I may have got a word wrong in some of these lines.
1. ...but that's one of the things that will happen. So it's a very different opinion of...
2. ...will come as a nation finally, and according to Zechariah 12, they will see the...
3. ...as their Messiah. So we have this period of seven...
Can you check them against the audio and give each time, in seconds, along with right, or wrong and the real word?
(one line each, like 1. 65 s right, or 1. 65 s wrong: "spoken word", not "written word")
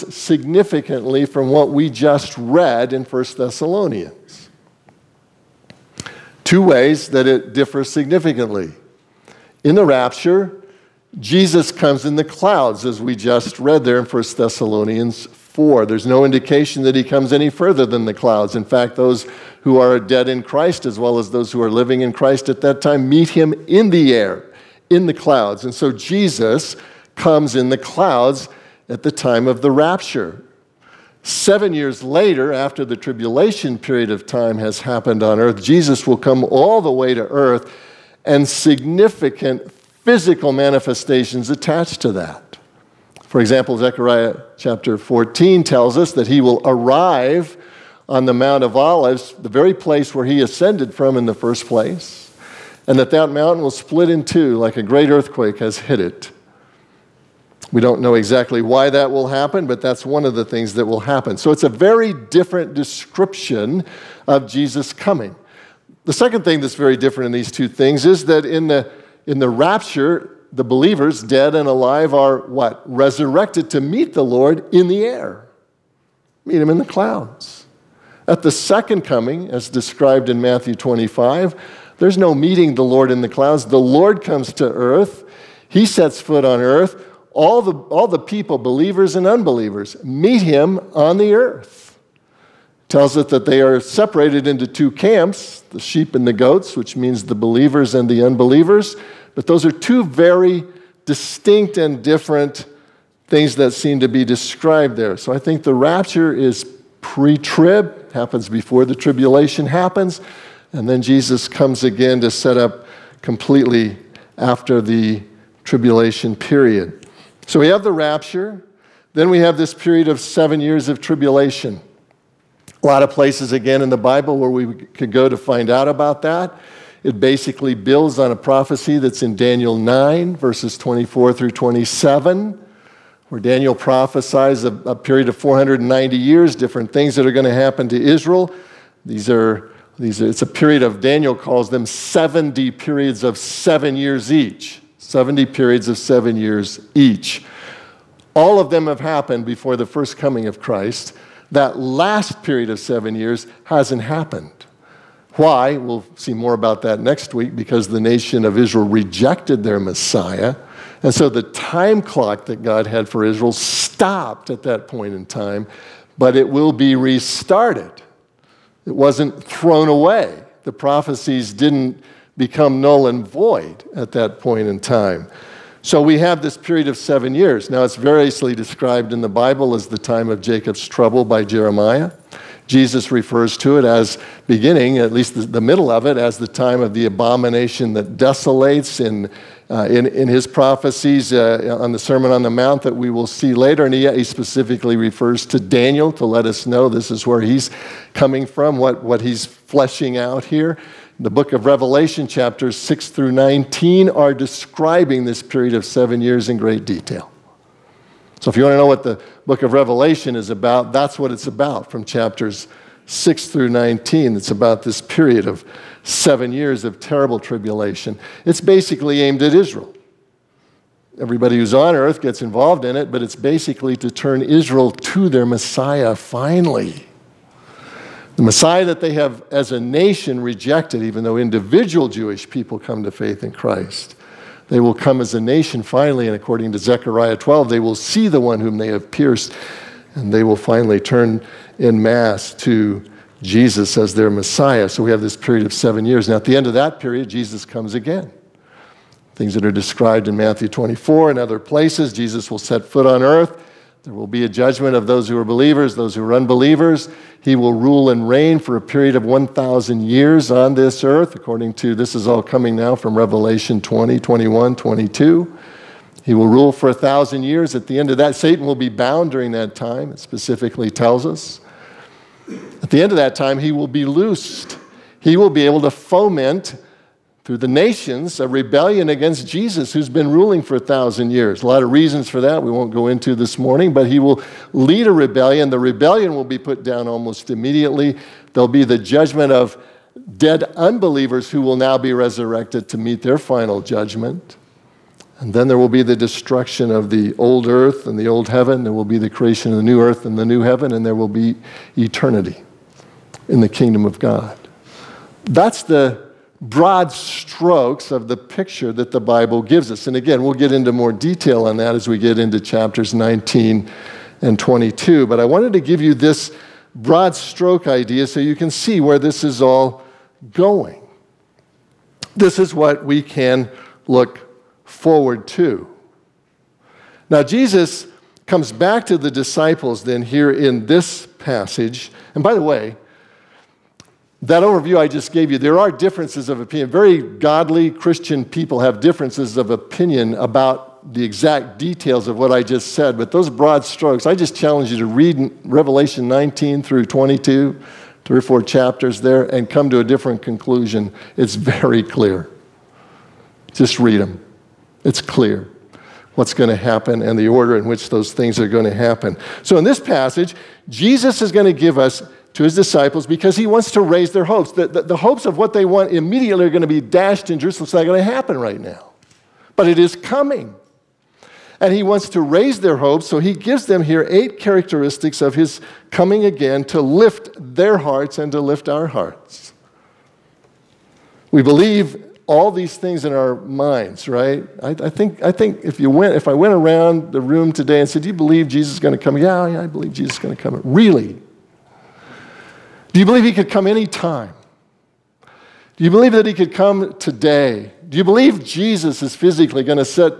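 1. 59 s wrong: "description", not "opinion"
2. 234 s right
3. 243 s right.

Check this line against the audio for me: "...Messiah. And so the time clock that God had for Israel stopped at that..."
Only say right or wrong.
right.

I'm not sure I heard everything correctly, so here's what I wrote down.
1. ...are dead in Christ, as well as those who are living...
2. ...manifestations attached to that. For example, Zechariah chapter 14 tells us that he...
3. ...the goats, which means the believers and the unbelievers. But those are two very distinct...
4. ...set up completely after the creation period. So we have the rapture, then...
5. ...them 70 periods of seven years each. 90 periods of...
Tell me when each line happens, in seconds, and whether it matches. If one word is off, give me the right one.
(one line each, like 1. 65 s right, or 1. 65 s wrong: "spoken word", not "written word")
1. 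19 s right
2. 40 s right
3. 96 s right
4. 112 s wrong: "tribulation", not "creation"
5. 141 s wrong: "70", not "90".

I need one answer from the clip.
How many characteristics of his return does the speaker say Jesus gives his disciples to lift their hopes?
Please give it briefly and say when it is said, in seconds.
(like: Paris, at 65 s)
8, at 374 s.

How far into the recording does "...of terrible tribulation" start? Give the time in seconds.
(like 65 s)
216 s.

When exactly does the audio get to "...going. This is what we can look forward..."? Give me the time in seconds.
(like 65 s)
320 s.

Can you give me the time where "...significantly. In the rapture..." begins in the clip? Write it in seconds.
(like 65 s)
7 s.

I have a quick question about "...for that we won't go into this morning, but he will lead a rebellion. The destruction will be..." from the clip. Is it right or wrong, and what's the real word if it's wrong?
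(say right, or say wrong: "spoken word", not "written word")
wrong: "rebellion", not "destruction".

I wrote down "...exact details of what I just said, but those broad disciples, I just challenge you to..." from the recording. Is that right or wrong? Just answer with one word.
wrong.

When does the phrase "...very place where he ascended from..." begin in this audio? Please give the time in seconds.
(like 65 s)
49 s.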